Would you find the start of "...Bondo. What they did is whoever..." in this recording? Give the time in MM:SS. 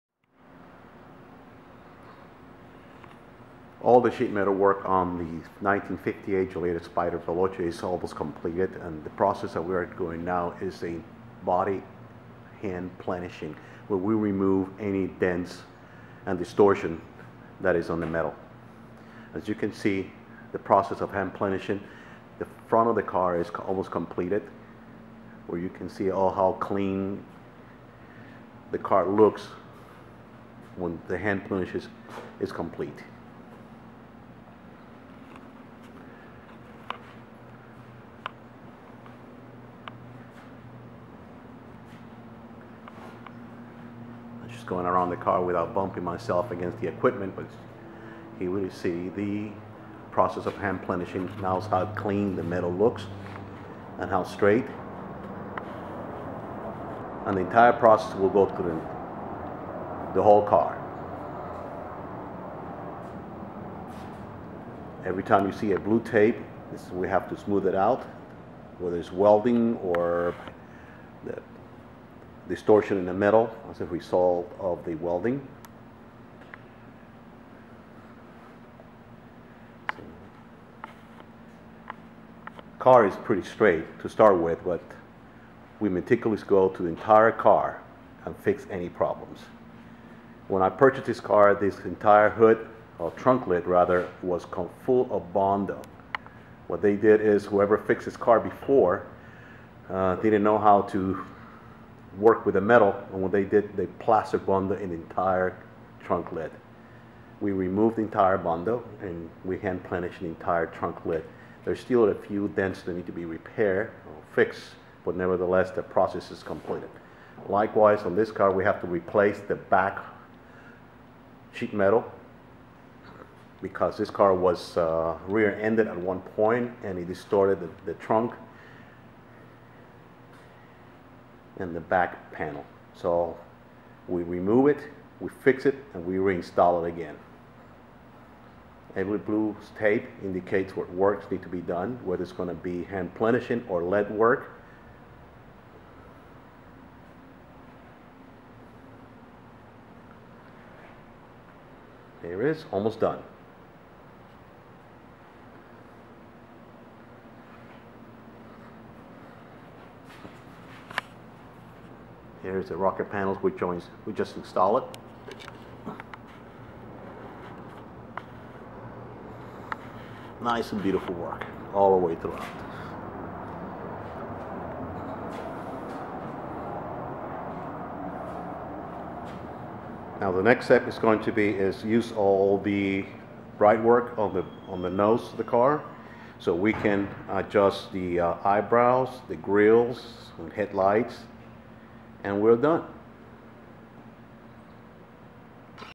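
01:35.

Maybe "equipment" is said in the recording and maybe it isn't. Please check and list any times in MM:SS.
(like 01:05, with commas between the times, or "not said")
00:46.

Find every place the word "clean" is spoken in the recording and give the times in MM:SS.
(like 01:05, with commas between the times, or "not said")
00:26, 00:51.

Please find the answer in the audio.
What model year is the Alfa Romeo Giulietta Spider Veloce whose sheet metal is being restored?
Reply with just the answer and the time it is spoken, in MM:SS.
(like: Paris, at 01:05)
1958, at 00:05.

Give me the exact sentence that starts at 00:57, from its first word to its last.
And the entire process will go through the, the whole car.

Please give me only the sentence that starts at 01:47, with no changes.
We removed the entire Bondo, and we hand planished the entire trunk lid.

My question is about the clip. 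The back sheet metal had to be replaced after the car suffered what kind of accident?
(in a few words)
Rear-ended.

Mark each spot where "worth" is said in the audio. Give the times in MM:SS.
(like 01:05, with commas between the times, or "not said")
not said.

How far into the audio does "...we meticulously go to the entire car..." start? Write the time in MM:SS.
01:25.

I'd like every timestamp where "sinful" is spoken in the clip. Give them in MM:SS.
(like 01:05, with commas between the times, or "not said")
not said.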